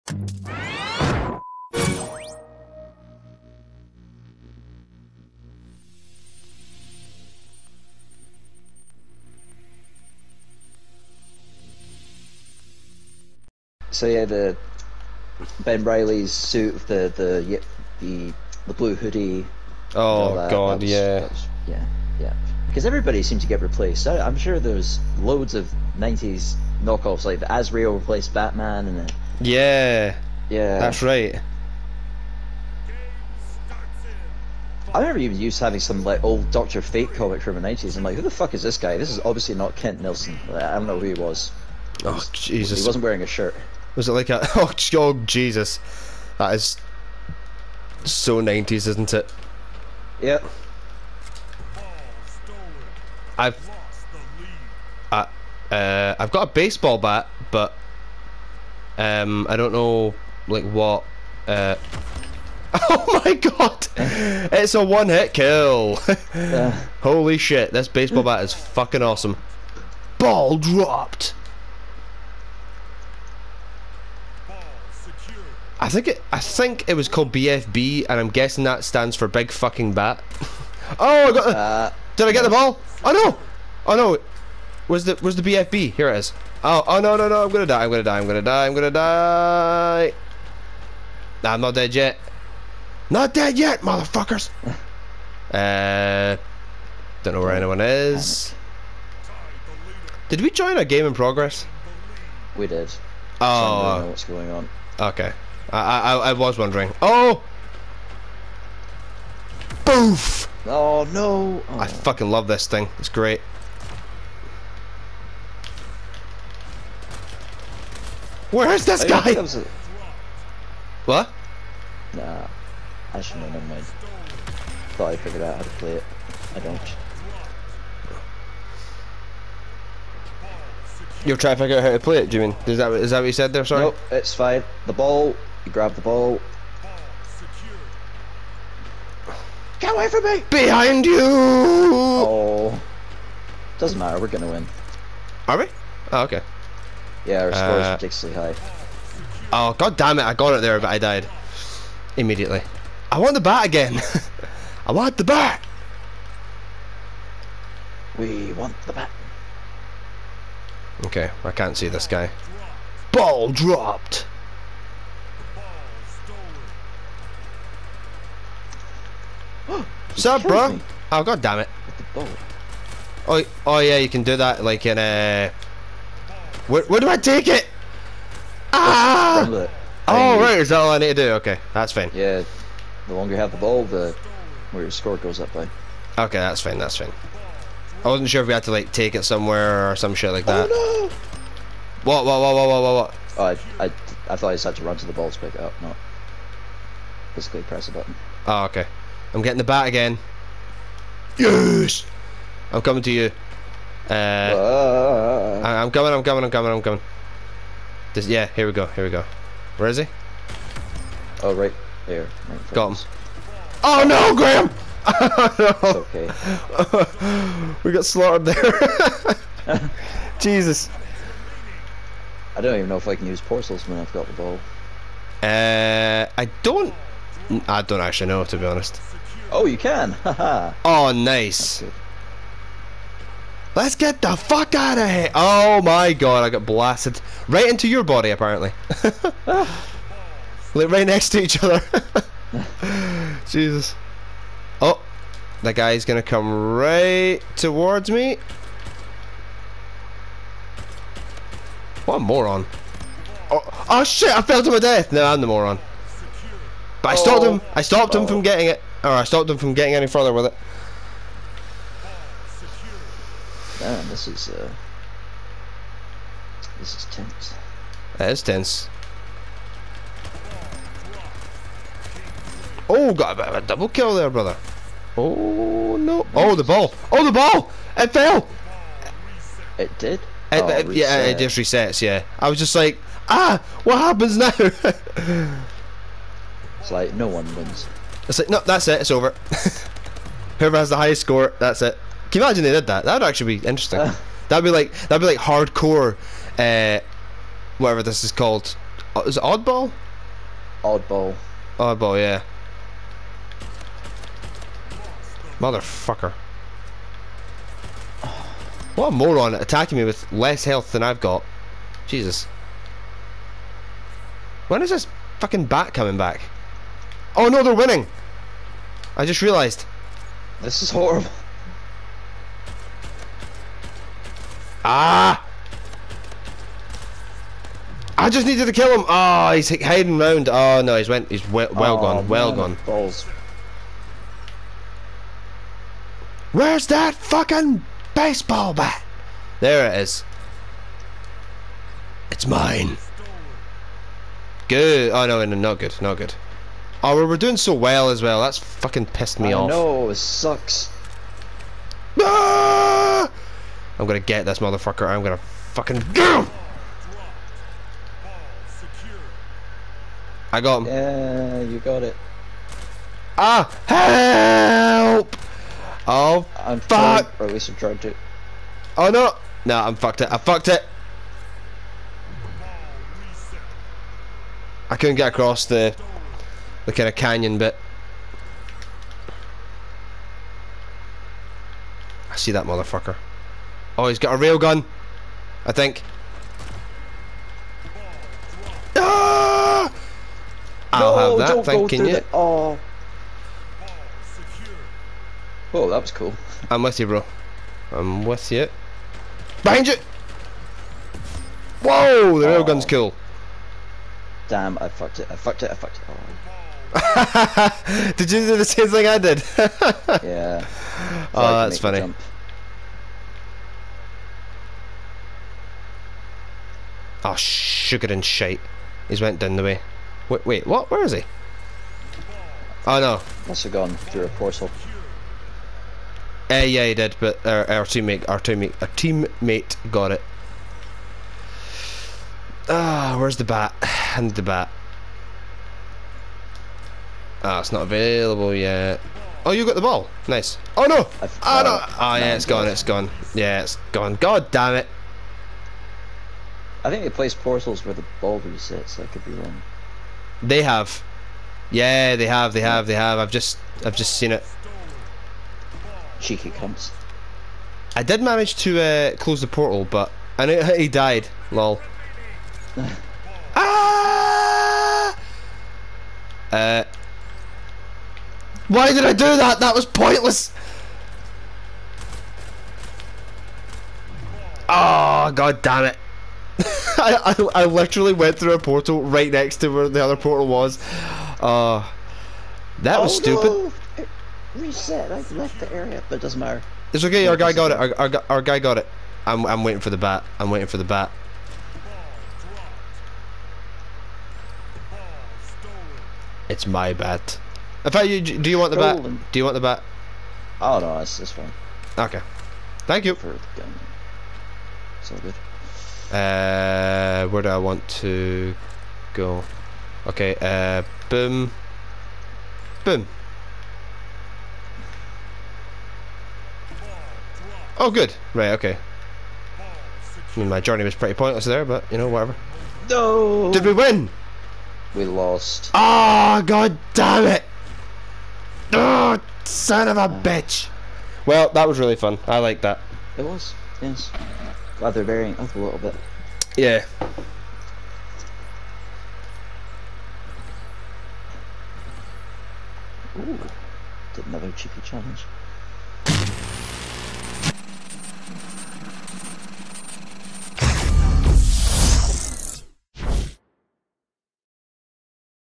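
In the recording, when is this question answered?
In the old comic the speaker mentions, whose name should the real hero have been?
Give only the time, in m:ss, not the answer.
0:39.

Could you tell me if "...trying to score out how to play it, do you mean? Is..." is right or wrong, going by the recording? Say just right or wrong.
wrong.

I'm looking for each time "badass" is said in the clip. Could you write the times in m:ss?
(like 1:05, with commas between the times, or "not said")
not said.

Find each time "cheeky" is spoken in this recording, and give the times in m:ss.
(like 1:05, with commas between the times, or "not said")
7:36, 9:04.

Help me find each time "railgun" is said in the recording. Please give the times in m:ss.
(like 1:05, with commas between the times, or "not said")
6:24, 6:42.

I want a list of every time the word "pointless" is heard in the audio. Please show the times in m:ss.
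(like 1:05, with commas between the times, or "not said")
7:49, 8:41.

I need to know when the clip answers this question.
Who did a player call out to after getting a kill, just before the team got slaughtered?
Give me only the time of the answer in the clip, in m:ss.
3:34.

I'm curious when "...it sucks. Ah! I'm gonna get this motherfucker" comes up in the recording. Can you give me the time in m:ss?
5:50.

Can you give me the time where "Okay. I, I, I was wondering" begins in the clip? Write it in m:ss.
1:44.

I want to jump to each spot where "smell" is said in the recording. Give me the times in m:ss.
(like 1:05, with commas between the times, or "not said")
not said.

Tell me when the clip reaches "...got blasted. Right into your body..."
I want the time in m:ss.
3:56.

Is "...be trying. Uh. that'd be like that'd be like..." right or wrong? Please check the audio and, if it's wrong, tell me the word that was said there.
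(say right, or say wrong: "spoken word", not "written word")
wrong: "interesting", not "trying".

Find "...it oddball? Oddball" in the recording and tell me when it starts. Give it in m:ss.
4:59.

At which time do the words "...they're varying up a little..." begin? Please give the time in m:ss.
8:54.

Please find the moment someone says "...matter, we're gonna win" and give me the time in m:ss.
2:23.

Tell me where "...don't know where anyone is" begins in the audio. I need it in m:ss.
1:37.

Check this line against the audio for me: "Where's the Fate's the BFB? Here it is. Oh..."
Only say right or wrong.
wrong.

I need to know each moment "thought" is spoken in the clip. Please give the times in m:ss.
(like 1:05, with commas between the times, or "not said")
2:04, 3:14.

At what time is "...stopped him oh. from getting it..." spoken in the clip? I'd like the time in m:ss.
4:17.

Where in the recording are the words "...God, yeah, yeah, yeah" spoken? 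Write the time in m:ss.
0:20.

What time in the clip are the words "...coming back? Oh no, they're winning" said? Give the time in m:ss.
5:15.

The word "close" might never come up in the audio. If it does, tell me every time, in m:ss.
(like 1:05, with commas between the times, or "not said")
7:39.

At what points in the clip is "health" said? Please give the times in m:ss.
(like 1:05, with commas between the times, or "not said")
5:10.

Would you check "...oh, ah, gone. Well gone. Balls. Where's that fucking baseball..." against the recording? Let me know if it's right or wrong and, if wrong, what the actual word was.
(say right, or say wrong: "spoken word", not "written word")
right.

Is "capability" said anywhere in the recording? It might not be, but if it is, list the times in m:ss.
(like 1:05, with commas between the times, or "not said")
not said.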